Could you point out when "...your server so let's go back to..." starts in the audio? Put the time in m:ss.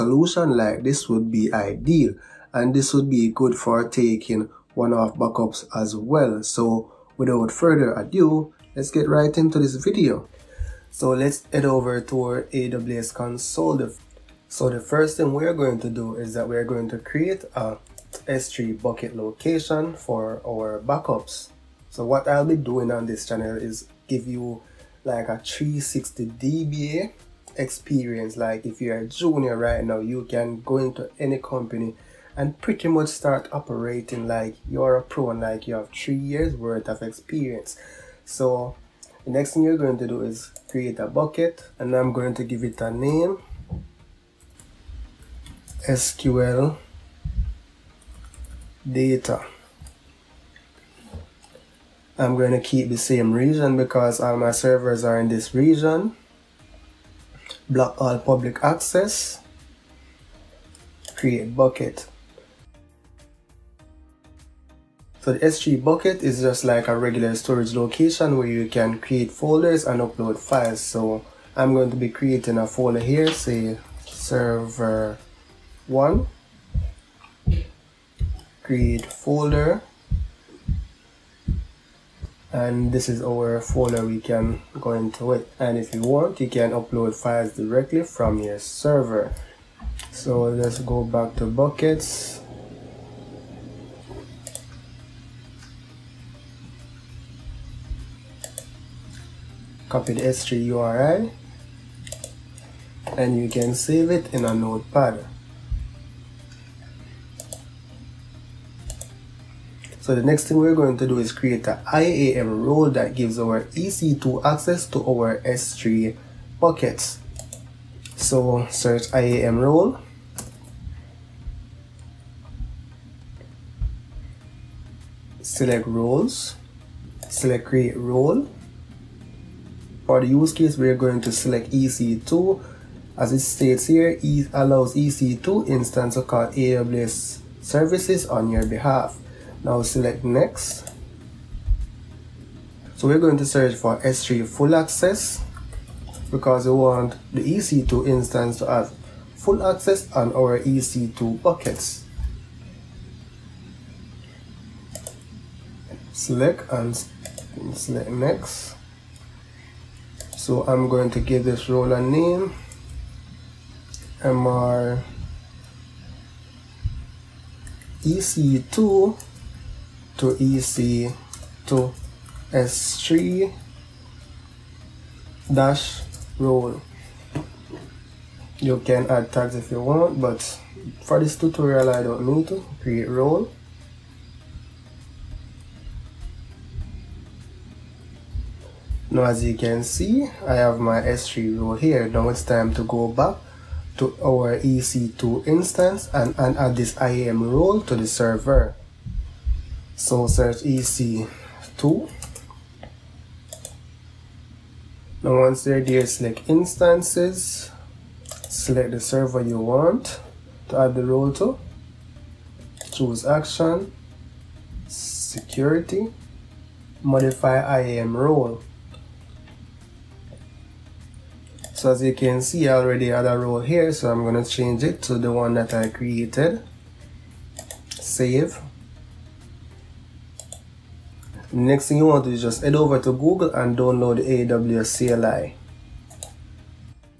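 1:28.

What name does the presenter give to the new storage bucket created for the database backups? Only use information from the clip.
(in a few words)
sql data.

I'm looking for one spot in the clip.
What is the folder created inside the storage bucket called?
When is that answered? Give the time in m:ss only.
1:14.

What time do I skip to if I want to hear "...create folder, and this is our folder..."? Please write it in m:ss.
1:18.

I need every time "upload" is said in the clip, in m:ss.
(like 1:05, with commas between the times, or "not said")
1:10, 1:26.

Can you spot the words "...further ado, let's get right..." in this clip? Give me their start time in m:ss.
0:07.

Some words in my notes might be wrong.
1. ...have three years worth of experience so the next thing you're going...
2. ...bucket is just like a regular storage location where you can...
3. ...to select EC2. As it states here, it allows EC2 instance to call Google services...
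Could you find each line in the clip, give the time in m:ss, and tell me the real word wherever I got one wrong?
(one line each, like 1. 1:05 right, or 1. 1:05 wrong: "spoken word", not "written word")
1. 0:35 right
2. 1:05 right
3. 2:11 wrong: "AWS", not "Google".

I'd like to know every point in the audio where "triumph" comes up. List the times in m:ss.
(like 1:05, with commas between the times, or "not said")
not said.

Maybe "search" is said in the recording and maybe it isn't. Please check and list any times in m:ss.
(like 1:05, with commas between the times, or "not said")
1:58, 2:23, 3:20.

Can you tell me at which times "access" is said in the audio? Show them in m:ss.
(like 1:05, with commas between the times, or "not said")
0:58, 1:54, 2:24, 2:29.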